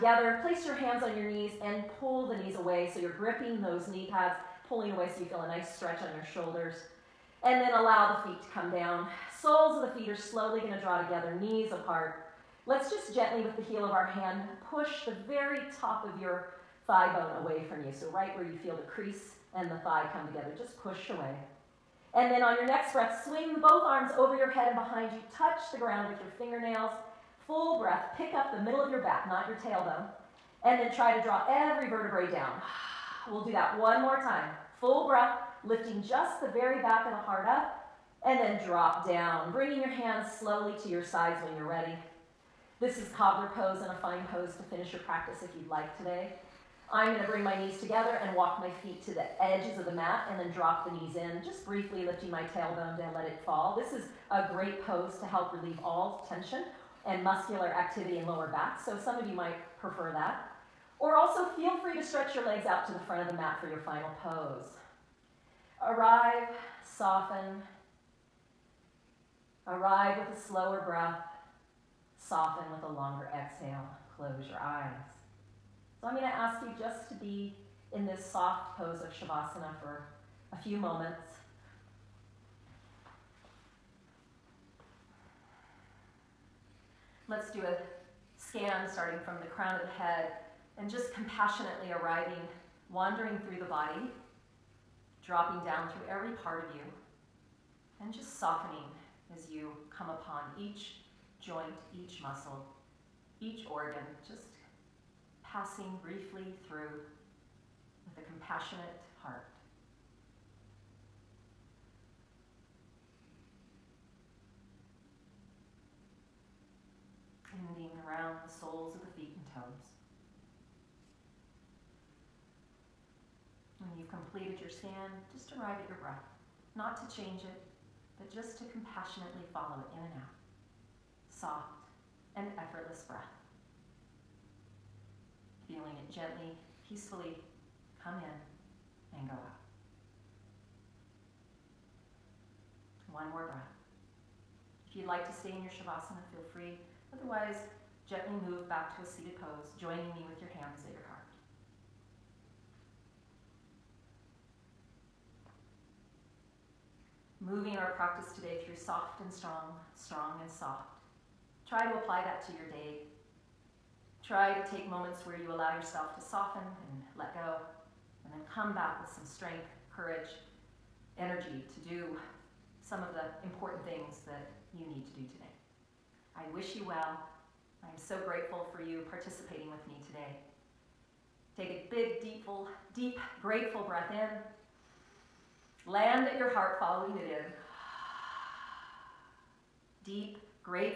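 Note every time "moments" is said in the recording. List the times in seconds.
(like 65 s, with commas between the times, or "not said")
80 s, 164 s.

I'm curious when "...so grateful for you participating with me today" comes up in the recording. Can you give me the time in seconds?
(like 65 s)
177 s.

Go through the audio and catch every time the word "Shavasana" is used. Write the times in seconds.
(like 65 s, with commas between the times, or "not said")
79 s, 145 s.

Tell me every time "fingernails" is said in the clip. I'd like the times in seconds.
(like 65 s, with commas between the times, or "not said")
26 s.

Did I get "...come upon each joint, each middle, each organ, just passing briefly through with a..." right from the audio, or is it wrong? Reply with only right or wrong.
wrong.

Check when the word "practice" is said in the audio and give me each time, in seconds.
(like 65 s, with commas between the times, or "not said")
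45 s, 157 s.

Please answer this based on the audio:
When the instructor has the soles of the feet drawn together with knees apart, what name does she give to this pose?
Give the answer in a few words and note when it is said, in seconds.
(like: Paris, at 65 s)
Cobbler pose, at 43 s.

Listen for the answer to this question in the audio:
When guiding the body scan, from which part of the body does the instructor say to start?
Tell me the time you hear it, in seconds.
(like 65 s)
89 s.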